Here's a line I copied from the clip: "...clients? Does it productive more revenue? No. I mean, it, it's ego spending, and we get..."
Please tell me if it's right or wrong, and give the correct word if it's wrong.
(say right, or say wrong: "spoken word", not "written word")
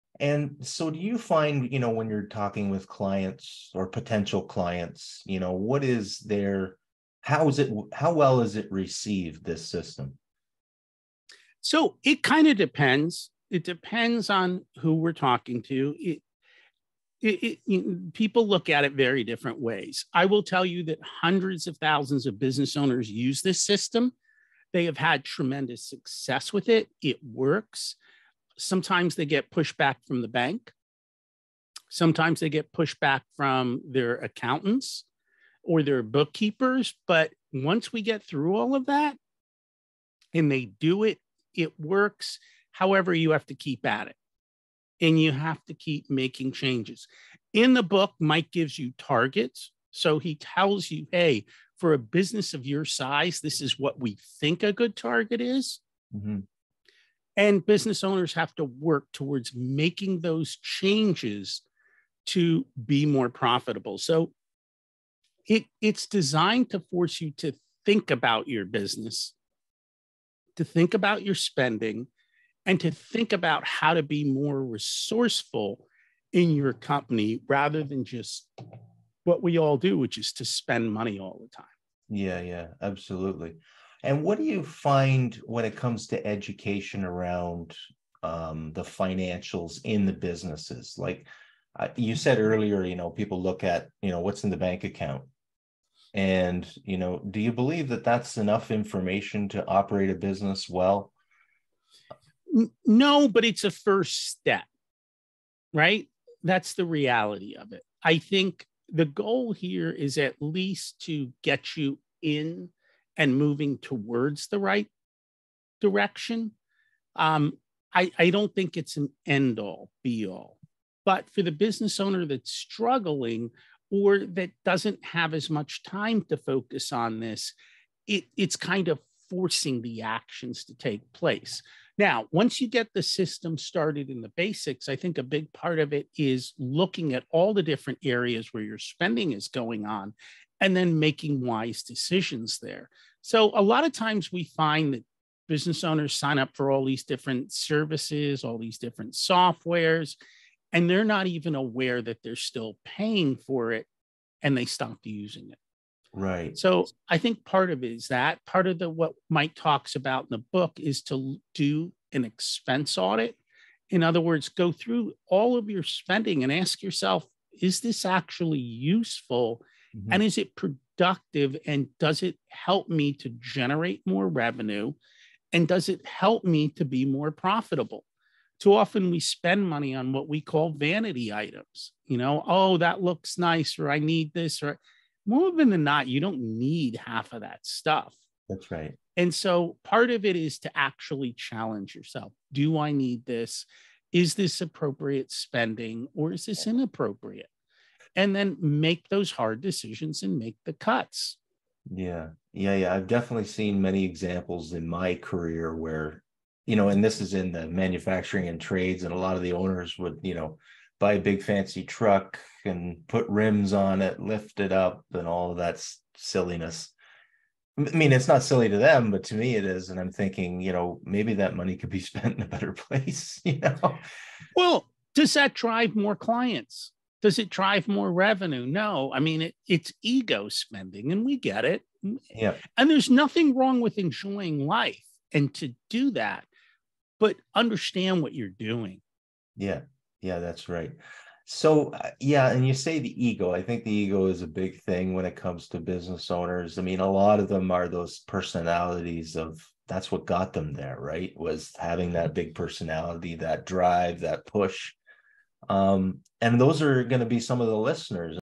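wrong: "drive", not "productive".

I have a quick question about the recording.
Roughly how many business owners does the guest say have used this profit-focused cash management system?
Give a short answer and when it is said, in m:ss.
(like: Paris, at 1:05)
hundreds of thousands, at 0:21.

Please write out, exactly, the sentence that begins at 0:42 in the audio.
However, you have to keep at it and you have to keep making changes.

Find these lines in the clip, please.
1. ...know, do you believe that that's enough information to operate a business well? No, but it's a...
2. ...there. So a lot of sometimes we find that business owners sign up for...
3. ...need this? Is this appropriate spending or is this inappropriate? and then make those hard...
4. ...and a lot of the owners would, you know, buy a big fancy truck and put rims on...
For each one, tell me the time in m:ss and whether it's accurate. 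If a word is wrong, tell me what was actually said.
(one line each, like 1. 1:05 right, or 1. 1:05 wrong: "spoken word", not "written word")
1. 1:36 right
2. 2:22 wrong: "times", not "sometimes"
3. 3:12 right
4. 3:29 right.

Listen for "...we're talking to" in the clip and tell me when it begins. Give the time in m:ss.
0:14.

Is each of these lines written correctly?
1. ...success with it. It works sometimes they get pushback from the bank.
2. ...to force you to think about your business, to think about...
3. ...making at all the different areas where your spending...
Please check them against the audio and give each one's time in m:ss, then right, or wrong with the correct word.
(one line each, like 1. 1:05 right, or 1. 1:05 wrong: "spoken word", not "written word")
1. 0:25 right
2. 1:06 right
3. 2:16 wrong: "looking", not "making".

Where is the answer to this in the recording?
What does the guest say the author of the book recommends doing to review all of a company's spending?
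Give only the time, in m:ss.
2:42.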